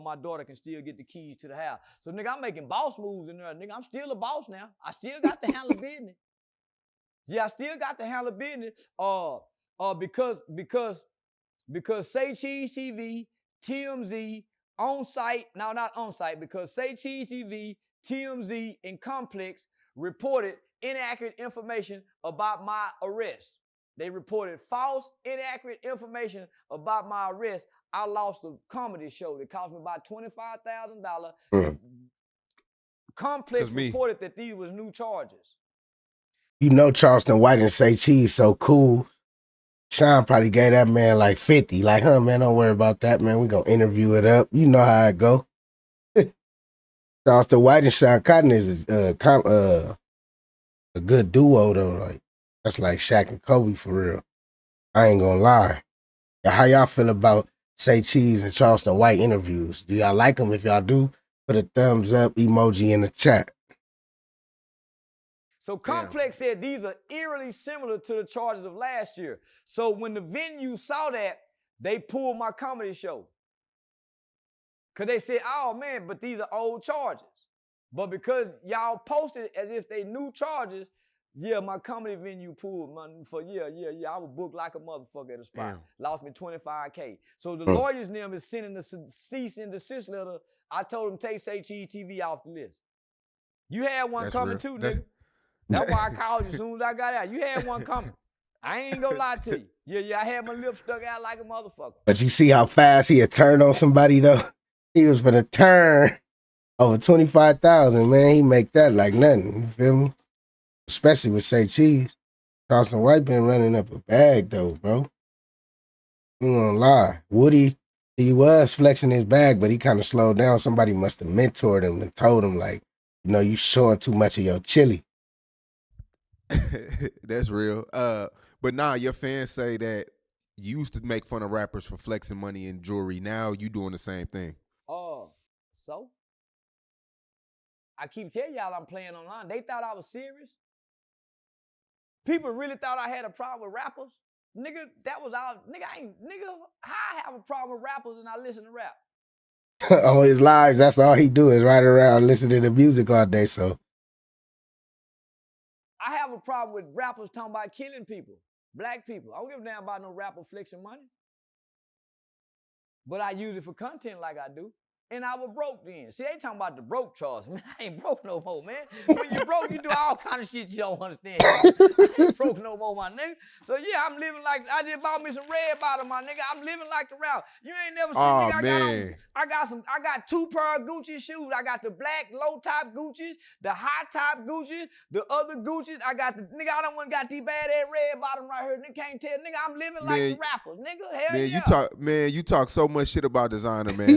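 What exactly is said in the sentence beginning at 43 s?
we going to interview it up.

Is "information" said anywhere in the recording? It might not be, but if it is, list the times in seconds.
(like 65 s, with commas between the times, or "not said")
21 s, 25 s.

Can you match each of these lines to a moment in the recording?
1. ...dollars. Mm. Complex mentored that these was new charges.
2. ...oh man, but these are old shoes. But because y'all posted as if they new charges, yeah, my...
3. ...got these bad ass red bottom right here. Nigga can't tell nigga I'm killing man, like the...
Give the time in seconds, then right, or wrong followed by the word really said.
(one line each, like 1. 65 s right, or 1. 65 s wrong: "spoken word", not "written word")
1. 31 s wrong: "reported", not "mentored"
2. 75 s wrong: "charges", not "shoes"
3. 187 s wrong: "living", not "killing".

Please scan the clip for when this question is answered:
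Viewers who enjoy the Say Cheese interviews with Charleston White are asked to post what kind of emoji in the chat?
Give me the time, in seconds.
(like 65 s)
61 s.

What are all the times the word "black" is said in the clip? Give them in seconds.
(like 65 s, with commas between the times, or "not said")
158 s, 181 s.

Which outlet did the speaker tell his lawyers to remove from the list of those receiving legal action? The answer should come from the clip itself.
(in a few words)
HETV.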